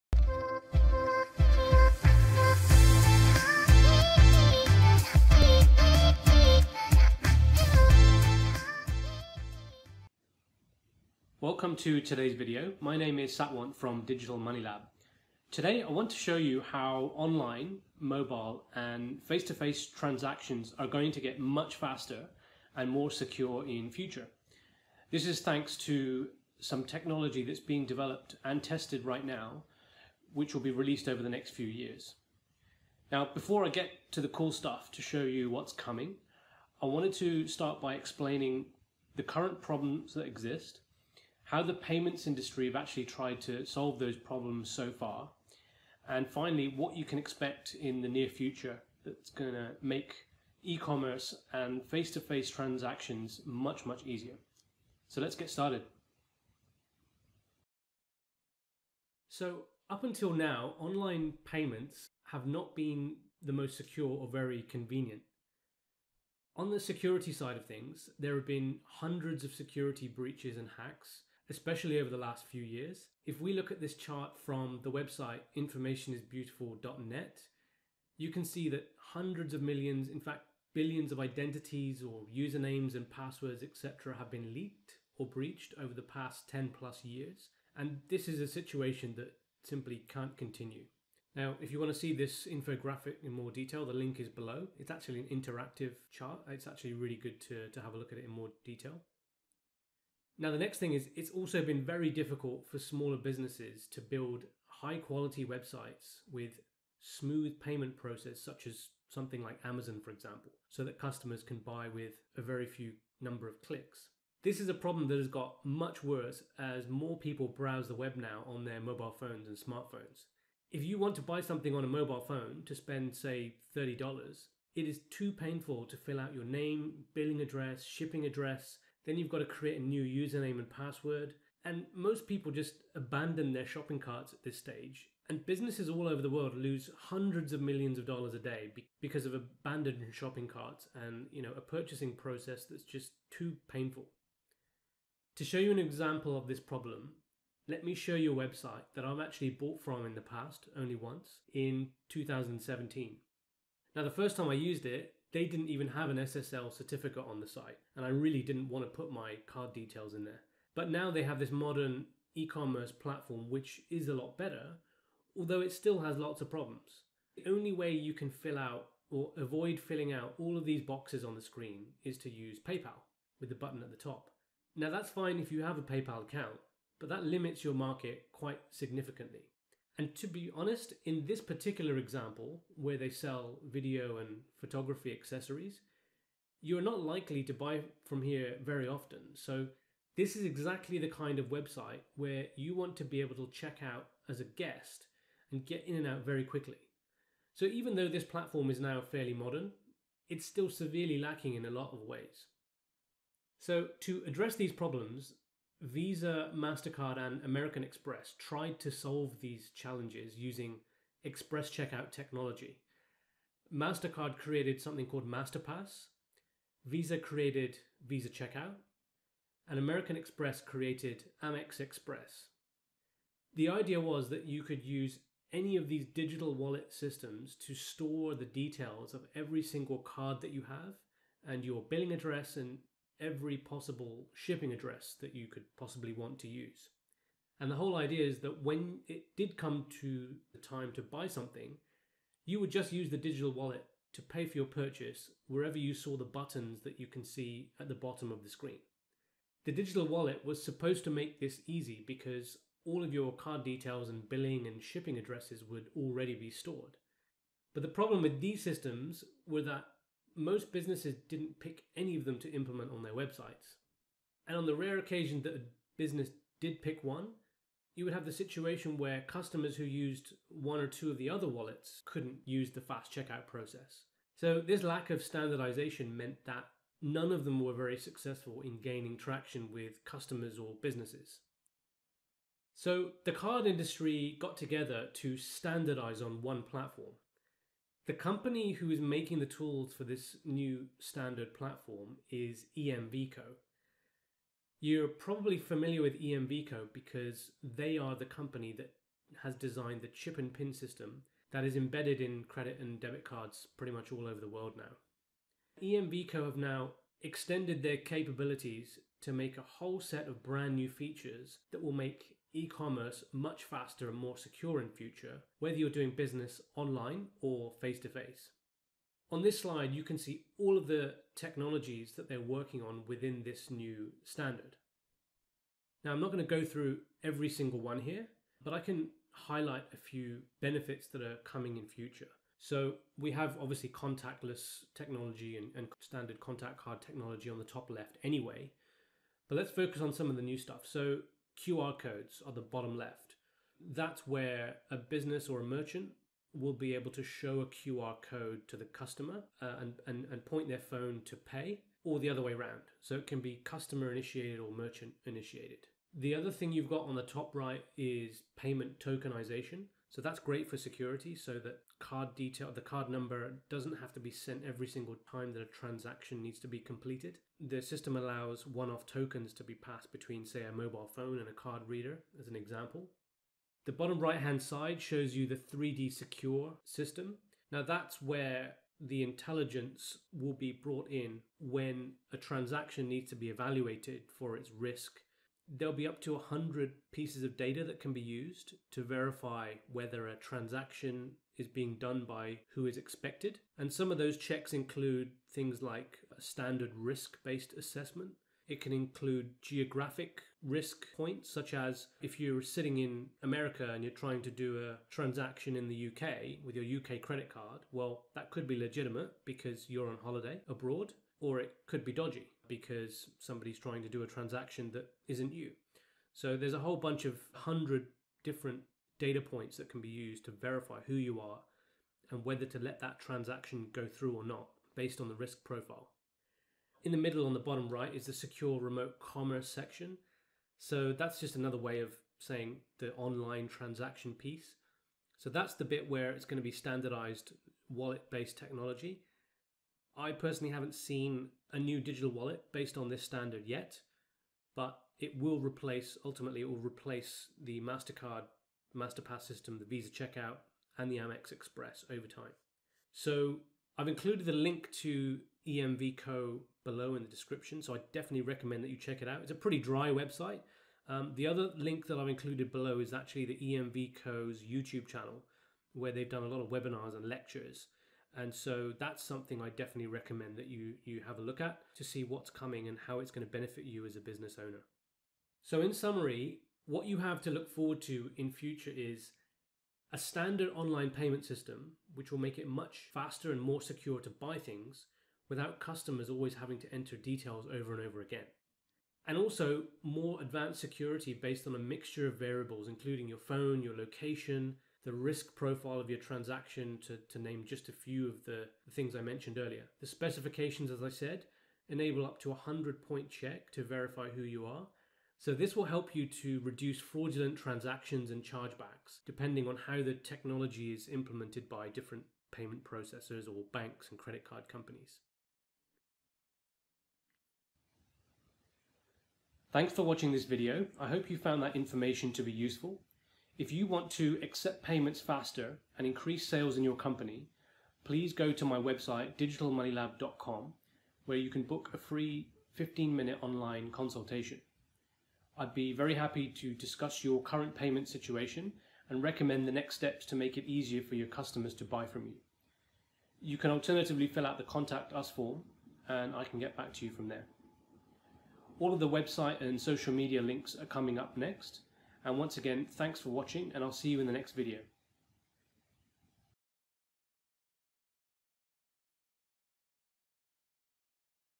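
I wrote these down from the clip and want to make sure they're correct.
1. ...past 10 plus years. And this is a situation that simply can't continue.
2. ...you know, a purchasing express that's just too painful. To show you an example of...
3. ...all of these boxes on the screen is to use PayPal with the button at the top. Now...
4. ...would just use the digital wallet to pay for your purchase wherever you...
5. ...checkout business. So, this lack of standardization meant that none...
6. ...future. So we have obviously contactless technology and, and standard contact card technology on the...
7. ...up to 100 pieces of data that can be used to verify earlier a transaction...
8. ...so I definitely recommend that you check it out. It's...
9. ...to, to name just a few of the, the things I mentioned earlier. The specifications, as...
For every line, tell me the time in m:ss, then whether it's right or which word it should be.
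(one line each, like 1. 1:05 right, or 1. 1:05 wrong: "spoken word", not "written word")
1. 1:26 right
2. 2:21 wrong: "process", not "express"
3. 2:50 right
4. 4:02 right
5. 4:33 wrong: "process", not "business"
6. 5:31 right
7. 6:26 wrong: "whether", not "earlier"
8. 7:37 right
9. 8:17 right.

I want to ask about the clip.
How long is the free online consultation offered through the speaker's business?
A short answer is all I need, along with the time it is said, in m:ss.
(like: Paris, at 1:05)
15 minutes, at 8:52.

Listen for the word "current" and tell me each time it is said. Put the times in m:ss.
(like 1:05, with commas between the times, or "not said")
0:39, 8:57.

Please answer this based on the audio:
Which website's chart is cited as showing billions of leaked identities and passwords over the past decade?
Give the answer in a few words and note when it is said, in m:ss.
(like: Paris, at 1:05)
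informationisbeautiful.net, at 1:15.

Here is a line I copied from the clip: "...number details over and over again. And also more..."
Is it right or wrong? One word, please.
wrong.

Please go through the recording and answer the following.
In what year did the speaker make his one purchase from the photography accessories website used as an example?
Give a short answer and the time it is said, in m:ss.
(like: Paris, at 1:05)
2017, at 2:32.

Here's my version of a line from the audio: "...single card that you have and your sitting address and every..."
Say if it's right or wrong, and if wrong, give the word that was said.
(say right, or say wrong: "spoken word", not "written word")
wrong: "billing", not "sitting".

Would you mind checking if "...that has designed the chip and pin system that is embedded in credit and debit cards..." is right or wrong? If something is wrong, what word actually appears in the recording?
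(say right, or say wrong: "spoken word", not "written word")
right.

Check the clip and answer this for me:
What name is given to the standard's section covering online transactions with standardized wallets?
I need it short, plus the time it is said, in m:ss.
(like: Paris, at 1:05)
Secure remote commerce, at 7:08.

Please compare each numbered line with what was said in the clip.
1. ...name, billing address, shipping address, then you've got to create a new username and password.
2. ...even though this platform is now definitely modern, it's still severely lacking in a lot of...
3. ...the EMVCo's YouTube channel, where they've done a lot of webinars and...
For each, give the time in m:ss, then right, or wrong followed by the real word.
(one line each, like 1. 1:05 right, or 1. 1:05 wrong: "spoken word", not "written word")
1. 2:06 right
2. 3:17 wrong: "fairly", not "definitely"
3. 7:43 right.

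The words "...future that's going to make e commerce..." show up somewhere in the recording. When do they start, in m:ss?
0:48.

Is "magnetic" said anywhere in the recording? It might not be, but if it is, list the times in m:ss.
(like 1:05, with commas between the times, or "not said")
not said.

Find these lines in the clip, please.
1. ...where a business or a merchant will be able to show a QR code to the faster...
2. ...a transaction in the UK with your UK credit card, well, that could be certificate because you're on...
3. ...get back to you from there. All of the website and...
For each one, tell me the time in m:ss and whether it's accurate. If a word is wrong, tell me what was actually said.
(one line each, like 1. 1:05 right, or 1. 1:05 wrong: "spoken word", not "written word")
1. 5:44 wrong: "customer", not "faster"
2. 6:44 wrong: "legitimate", not "certificate"
3. 9:06 right.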